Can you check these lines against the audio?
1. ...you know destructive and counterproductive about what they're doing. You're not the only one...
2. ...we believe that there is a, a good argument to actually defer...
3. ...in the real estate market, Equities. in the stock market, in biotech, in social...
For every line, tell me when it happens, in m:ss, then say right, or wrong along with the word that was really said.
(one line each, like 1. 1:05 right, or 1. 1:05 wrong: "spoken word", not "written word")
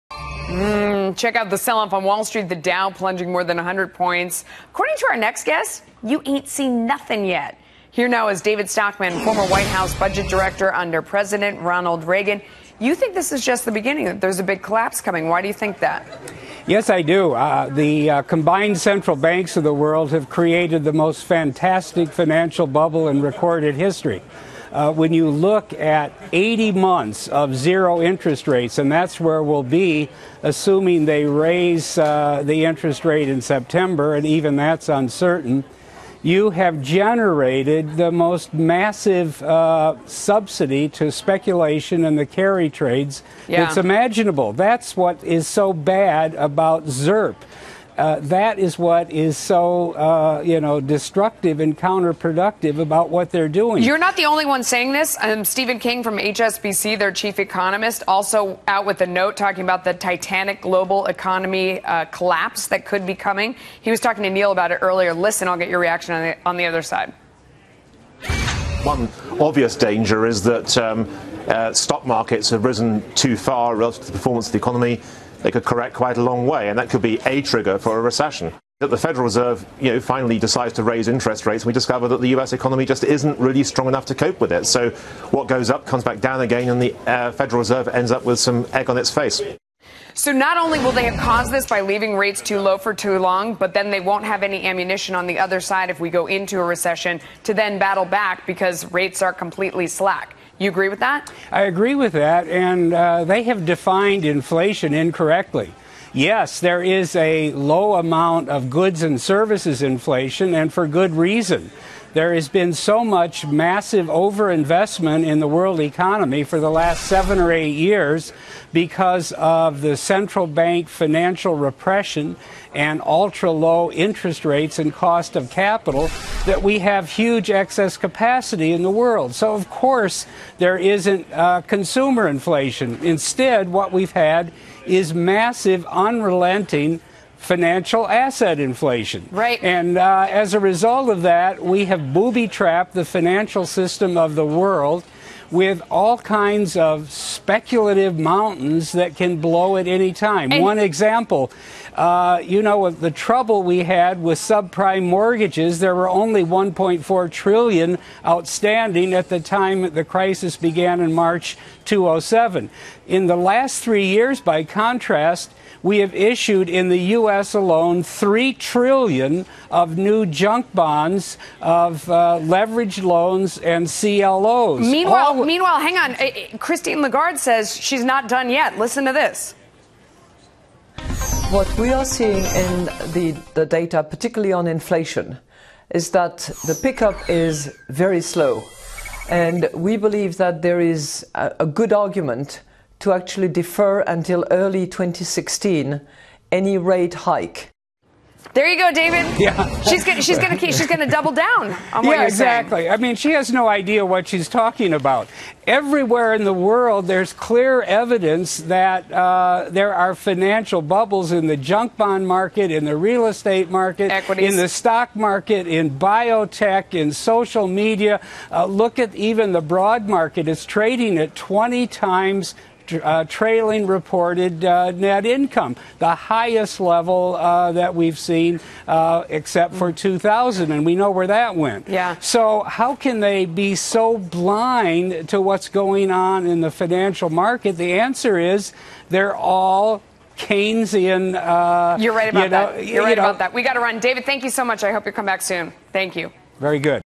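1. 0:50 right
2. 3:09 right
3. 3:32 right.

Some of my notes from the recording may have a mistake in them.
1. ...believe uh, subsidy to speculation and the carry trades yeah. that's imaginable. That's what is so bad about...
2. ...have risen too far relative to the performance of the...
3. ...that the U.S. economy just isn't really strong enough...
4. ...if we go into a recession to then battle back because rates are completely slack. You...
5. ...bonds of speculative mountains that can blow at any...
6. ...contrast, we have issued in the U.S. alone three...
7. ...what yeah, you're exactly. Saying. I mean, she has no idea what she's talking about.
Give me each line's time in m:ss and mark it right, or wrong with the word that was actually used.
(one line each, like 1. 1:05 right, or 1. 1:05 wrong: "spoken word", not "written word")
1. 0:38 wrong: "massive", not "believe"
2. 1:12 right
3. 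1:22 right
4. 1:35 right
5. 2:26 wrong: "kinds", not "bonds"
6. 2:44 right
7. 3:22 right.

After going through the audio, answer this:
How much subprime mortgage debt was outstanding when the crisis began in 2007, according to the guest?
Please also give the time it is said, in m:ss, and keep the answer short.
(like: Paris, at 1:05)
1.4 trillion, at 2:36.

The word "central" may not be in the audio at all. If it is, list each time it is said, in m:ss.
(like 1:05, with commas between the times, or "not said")
0:18, 1:59.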